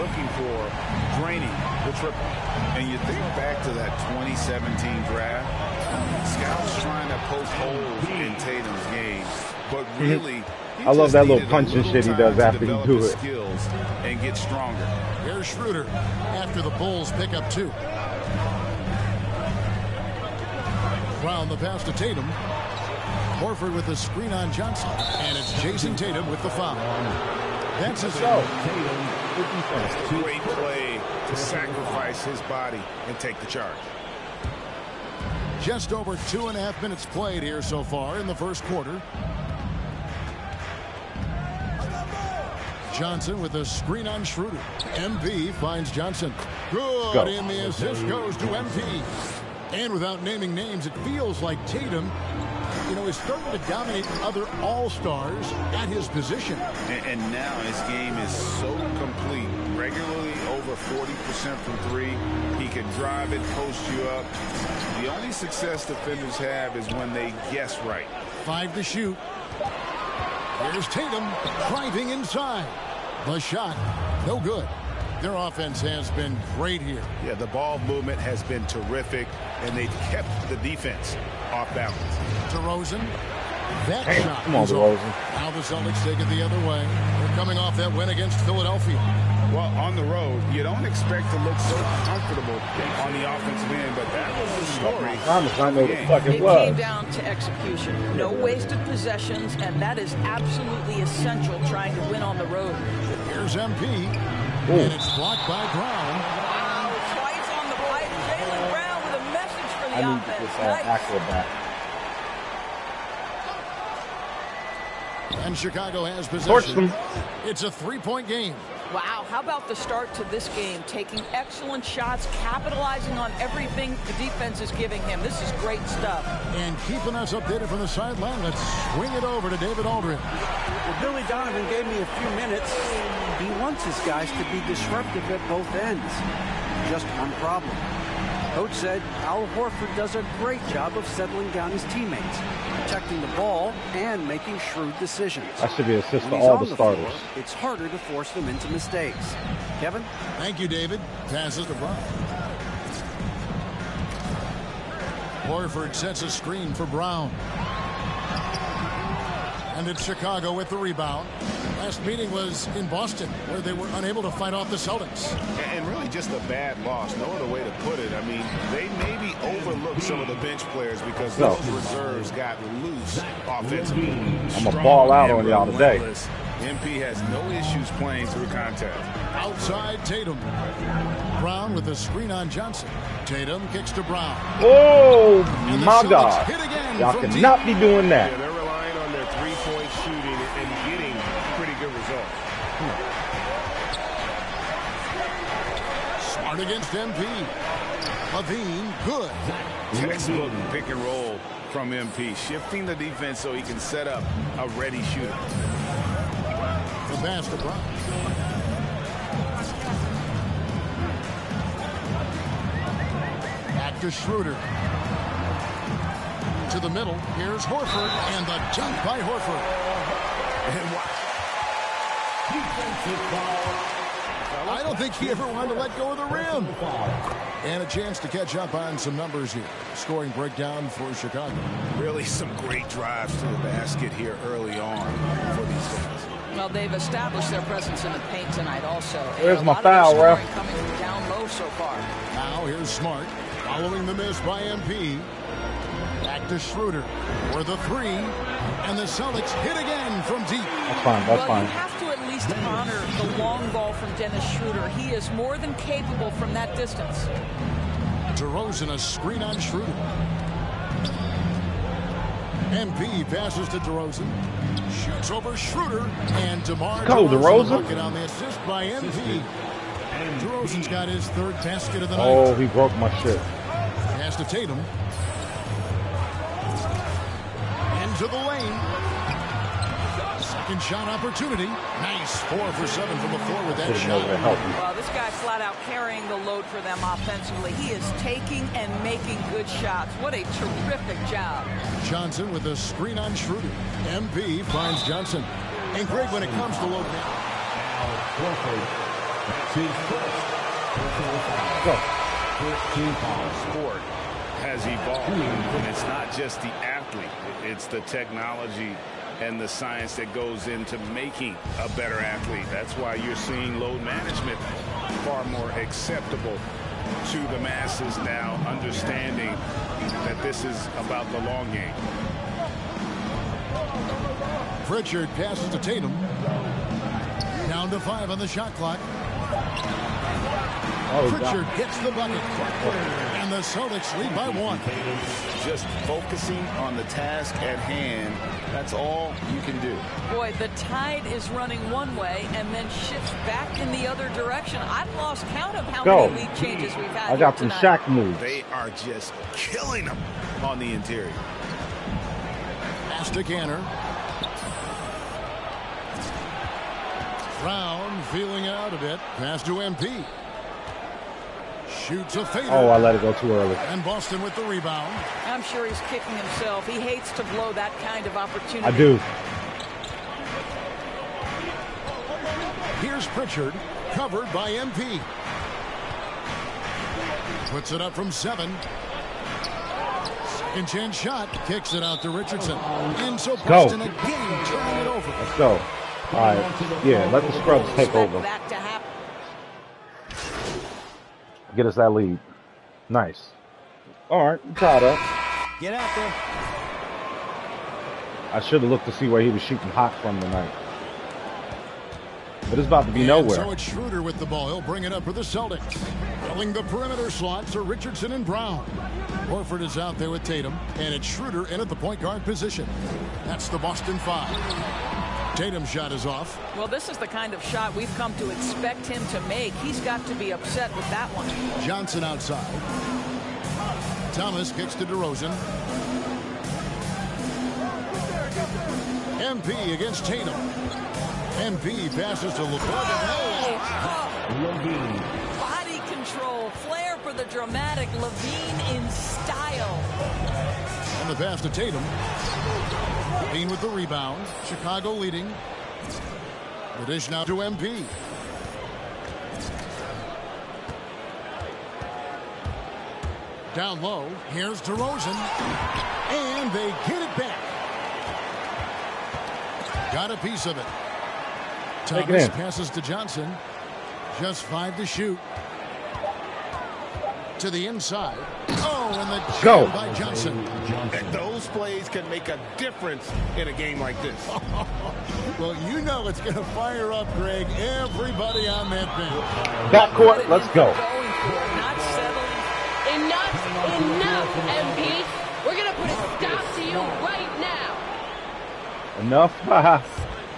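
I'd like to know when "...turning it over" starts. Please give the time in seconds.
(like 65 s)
384 s.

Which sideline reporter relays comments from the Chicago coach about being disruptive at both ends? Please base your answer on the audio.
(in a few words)
David Aldridge.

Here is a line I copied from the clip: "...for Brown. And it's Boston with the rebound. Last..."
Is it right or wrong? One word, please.
wrong.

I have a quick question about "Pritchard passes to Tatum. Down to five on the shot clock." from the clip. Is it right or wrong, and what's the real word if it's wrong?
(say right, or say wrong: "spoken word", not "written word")
right.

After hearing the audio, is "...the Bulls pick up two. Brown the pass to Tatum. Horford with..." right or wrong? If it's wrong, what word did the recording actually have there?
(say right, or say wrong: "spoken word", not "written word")
right.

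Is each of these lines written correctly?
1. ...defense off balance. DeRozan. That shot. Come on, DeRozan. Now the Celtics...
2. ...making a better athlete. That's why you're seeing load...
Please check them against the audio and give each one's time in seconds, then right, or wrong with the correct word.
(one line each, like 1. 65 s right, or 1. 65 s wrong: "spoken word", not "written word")
1. 80 s right
2. 311 s right.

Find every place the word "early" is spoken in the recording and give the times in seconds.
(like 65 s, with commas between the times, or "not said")
234 s, 363 s.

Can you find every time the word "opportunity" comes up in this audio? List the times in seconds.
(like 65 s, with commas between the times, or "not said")
281 s, 368 s.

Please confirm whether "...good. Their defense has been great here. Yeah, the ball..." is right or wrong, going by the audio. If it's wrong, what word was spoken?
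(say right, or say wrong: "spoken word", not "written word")
wrong: "offense", not "defense".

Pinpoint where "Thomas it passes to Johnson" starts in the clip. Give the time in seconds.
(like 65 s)
462 s.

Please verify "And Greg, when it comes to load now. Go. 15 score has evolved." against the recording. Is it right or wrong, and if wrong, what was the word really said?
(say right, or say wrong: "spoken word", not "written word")
wrong: "13", not "15".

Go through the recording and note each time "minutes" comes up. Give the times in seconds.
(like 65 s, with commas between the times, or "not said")
36 s, 132 s.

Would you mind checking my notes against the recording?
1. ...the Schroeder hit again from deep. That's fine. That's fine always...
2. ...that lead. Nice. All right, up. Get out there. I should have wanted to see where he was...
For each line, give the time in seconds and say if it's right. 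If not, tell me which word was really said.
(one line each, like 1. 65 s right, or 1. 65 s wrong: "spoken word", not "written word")
1. 248 s wrong: "Celtics", not "Schroeder"
2. 391 s wrong: "looked", not "wanted".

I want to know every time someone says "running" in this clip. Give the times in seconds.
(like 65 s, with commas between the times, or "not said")
341 s.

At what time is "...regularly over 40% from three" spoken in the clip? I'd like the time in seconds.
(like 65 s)
59 s.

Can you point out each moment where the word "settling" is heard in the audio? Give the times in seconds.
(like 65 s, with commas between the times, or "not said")
141 s, 482 s.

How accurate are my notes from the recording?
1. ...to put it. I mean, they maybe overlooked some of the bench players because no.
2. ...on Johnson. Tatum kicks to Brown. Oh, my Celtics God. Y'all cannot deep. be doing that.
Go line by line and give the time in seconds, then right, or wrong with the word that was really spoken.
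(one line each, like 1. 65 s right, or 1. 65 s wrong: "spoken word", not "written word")
1. 167 s right
2. 182 s right.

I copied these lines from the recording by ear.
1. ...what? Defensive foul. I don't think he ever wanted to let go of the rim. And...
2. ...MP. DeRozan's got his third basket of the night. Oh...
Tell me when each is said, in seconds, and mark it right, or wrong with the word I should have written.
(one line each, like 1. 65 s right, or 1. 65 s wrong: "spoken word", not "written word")
1. 220 s right
2. 268 s right.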